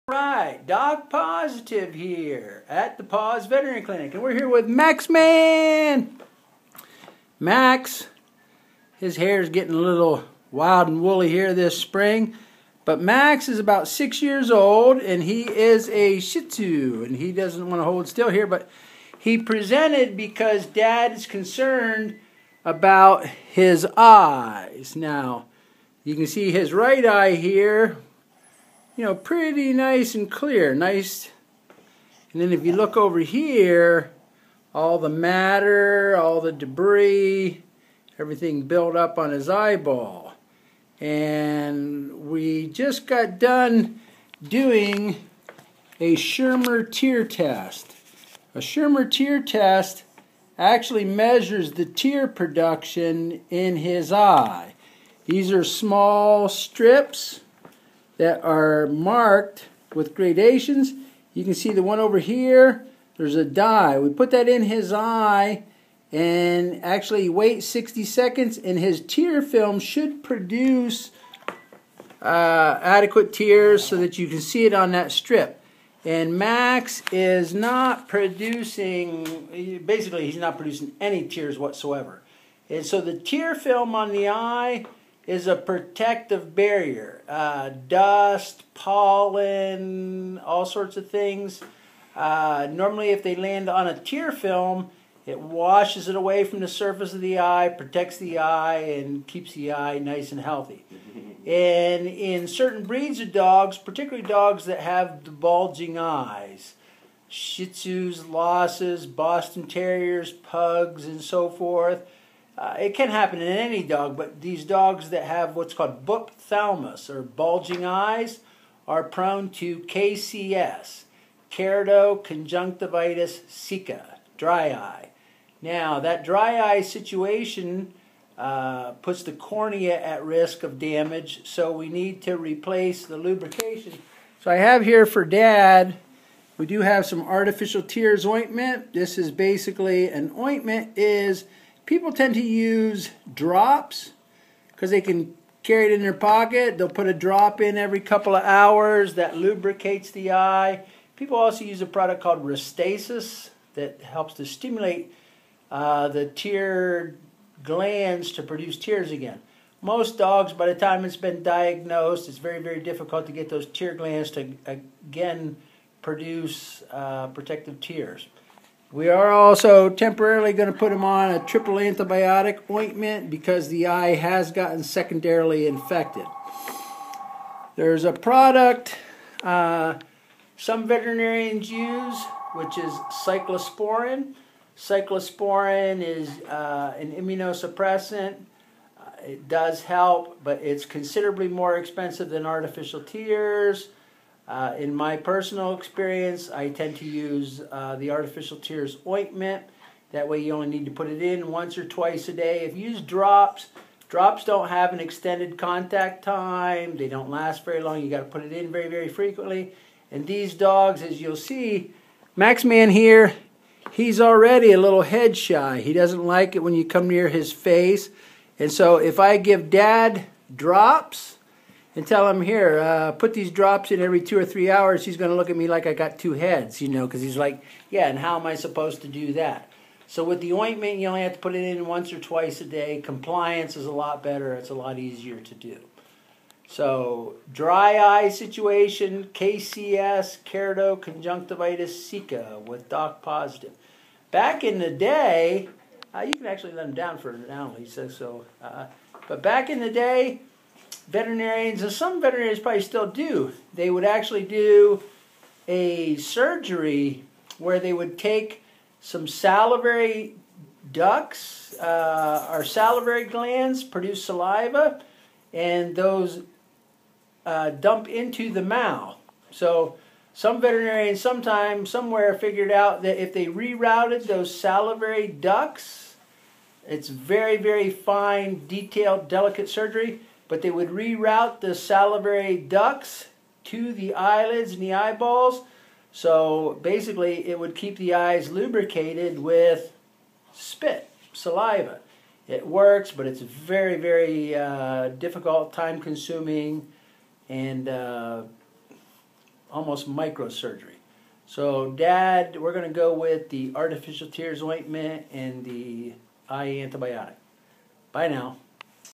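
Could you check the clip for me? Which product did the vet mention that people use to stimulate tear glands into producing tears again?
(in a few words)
Restasis.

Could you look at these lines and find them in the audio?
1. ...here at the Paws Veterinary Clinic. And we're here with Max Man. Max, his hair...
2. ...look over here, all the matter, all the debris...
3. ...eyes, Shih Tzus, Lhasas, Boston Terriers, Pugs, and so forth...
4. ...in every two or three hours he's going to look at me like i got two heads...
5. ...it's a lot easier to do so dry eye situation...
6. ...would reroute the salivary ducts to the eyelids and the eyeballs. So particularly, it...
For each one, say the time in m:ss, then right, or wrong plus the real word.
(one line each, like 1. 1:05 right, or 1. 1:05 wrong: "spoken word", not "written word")
1. 0:01 right
2. 0:32 right
3. 1:45 right
4. 3:43 right
5. 3:54 right
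6. 4:40 wrong: "basically", not "particularly".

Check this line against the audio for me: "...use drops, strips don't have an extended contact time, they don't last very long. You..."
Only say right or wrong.
wrong.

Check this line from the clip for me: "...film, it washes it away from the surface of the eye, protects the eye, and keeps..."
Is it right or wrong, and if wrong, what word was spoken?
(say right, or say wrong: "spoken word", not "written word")
right.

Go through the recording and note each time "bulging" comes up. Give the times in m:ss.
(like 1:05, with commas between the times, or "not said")
1:45, 1:57.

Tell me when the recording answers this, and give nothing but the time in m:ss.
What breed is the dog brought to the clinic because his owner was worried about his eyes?
0:16.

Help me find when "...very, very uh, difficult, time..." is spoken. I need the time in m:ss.
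4:53.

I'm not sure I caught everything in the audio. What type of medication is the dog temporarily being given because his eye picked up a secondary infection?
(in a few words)
triple antibiotic ointment.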